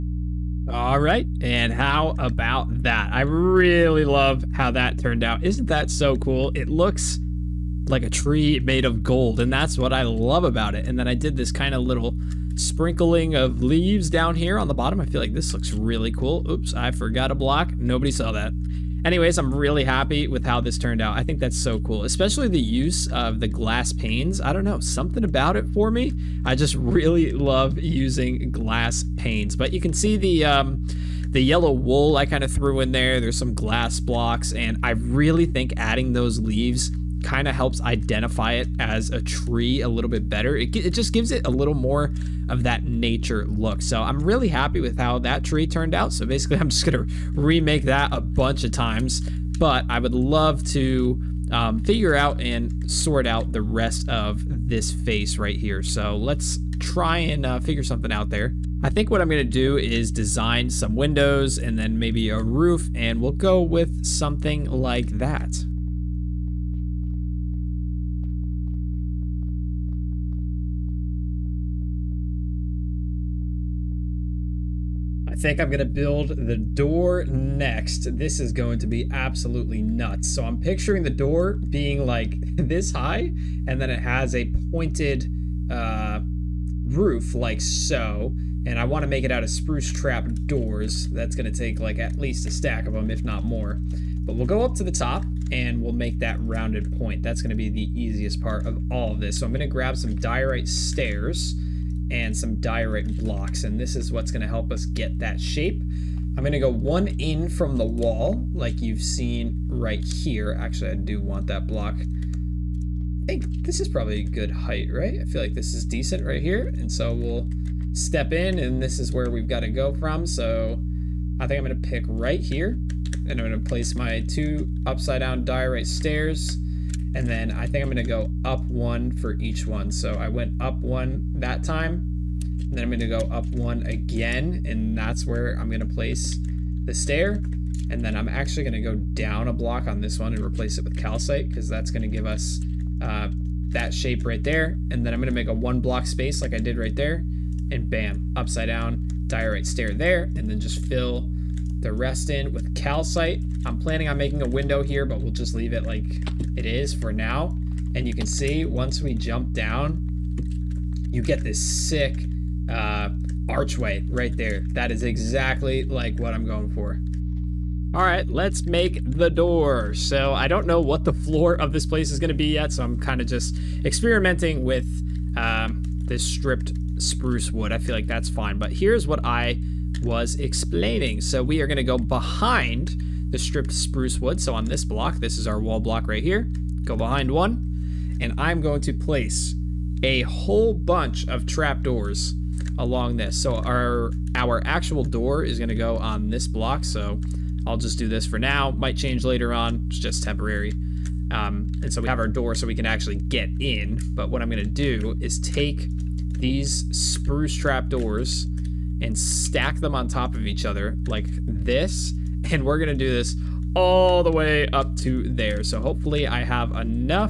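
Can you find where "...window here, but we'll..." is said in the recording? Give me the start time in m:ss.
2:34.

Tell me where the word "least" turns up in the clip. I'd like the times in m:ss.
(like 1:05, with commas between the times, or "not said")
1:32.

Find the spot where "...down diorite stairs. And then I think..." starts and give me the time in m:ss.
2:05.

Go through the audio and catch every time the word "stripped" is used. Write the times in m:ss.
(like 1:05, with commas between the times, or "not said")
2:56, 3:03.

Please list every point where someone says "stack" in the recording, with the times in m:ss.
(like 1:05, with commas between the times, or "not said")
1:32, 3:29.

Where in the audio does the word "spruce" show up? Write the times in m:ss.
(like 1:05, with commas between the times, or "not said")
1:29, 2:56, 3:03, 3:26.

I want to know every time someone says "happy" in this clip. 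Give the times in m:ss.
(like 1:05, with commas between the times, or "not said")
0:19, 0:44.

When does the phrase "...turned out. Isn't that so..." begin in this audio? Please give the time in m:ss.
0:04.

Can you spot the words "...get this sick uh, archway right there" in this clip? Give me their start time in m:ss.
2:41.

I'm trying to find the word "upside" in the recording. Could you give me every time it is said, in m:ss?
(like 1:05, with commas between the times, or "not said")
2:04, 2:28.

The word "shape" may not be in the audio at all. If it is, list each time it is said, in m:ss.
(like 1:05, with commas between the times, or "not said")
1:45, 2:23.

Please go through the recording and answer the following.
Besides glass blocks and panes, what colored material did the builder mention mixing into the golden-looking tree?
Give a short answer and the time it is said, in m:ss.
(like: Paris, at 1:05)
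yellow wool, at 0:31.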